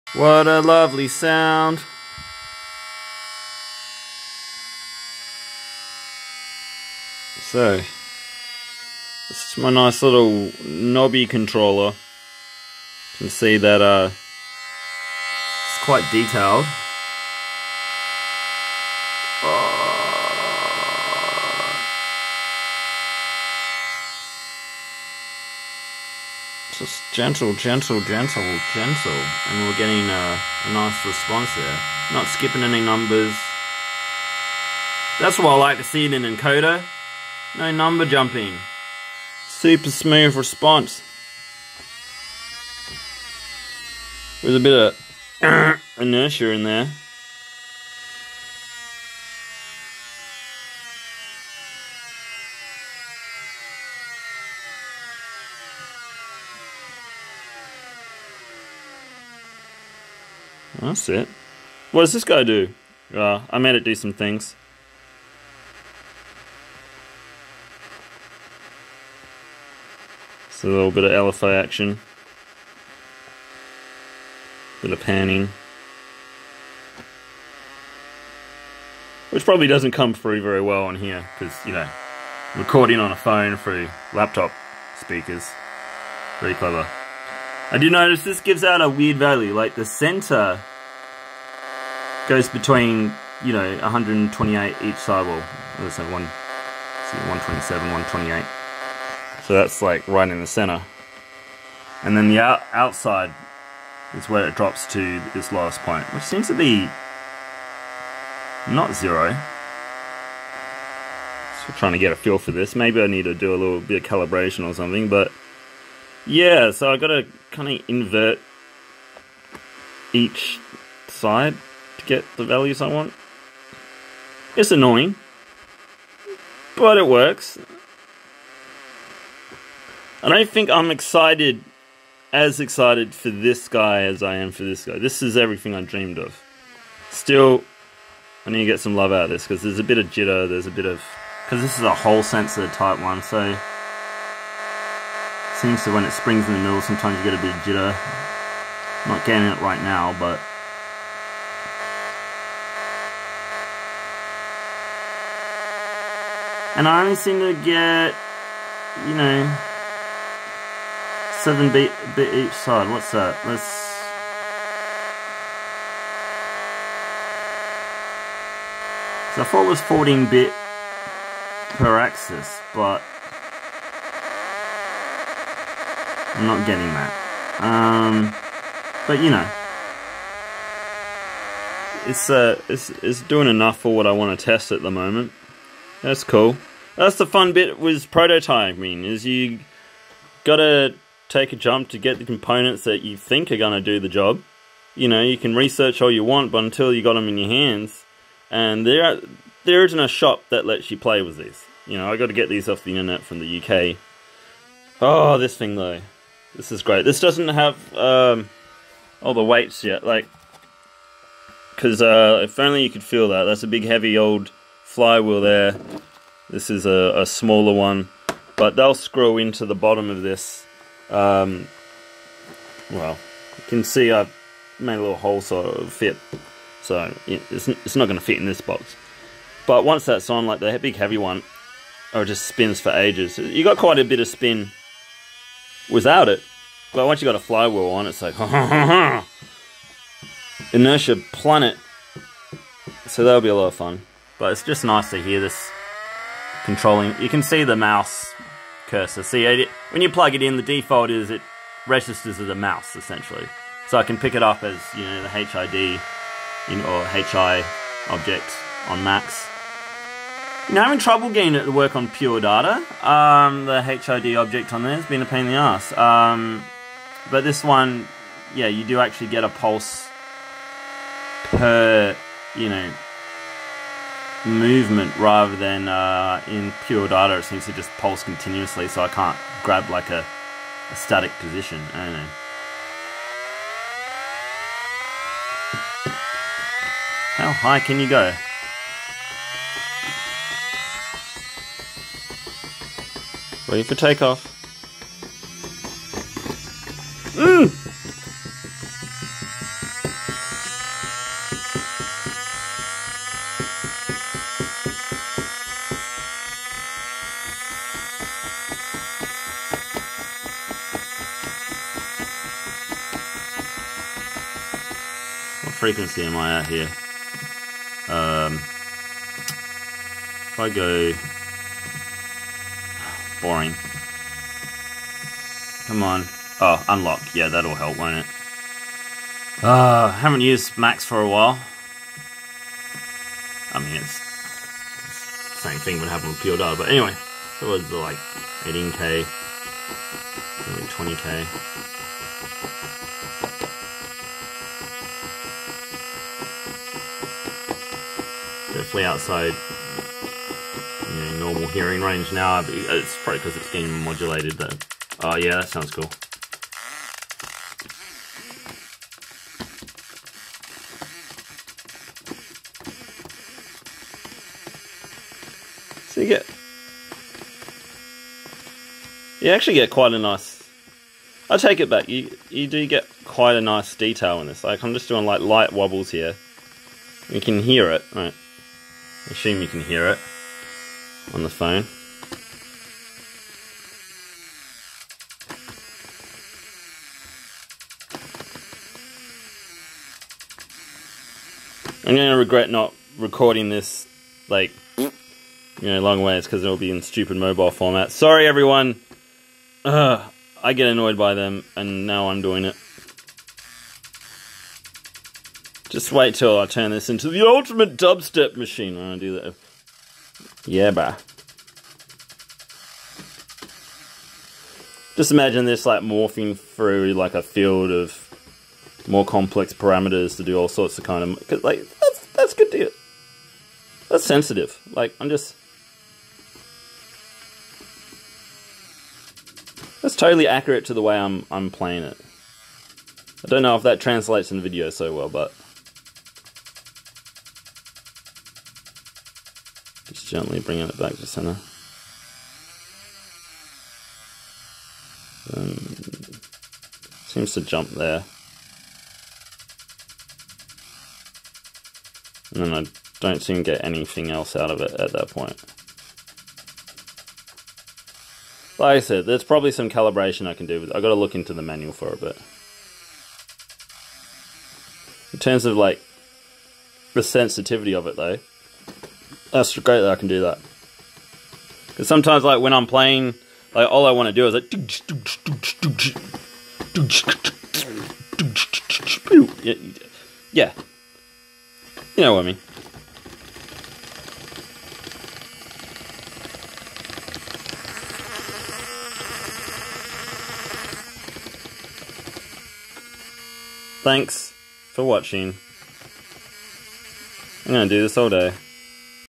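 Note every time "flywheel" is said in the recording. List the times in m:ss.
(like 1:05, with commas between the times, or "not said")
3:34, 3:57.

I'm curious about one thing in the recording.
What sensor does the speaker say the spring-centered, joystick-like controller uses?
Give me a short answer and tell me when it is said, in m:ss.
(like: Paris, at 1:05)
Hall sensor, at 2:21.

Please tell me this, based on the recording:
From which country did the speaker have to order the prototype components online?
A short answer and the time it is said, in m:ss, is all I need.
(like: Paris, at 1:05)
UK, at 3:23.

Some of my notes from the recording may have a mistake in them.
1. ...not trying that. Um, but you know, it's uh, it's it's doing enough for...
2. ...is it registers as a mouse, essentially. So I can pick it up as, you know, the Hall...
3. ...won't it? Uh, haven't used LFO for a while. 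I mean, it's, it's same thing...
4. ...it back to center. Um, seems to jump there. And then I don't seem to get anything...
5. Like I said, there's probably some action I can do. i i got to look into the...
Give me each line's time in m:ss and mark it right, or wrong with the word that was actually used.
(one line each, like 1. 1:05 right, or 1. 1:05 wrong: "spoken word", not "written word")
1. 2:56 wrong: "getting", not "trying"
2. 4:11 wrong: "HID", not "Hall"
3. 5:27 wrong: "Max", not "LFO"
4. 7:20 right
5. 7:38 wrong: "calibration", not "action".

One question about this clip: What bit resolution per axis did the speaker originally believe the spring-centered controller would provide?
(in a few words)
14 bit.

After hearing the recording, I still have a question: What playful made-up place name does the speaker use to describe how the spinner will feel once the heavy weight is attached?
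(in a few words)
Inertia Planet.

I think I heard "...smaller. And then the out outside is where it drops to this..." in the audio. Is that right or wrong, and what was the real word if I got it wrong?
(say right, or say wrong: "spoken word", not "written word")
wrong: "center", not "smaller".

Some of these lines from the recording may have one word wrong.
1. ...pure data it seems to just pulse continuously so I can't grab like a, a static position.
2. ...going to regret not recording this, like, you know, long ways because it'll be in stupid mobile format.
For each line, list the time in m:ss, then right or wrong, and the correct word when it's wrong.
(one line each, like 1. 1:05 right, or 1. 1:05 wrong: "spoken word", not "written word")
1. 4:36 right
2. 6:32 right.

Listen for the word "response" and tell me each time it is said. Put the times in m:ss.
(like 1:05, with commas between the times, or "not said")
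0:31, 0:40.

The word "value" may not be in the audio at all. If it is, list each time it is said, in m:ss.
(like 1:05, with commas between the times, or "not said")
1:29, 2:02.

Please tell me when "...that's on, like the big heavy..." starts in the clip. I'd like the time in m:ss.
3:50.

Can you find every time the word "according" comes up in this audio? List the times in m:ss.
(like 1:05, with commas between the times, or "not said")
not said.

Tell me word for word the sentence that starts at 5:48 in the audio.
definitely outside you know, normal hearing range now.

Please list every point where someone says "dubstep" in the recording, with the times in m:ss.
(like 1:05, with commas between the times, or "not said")
6:47.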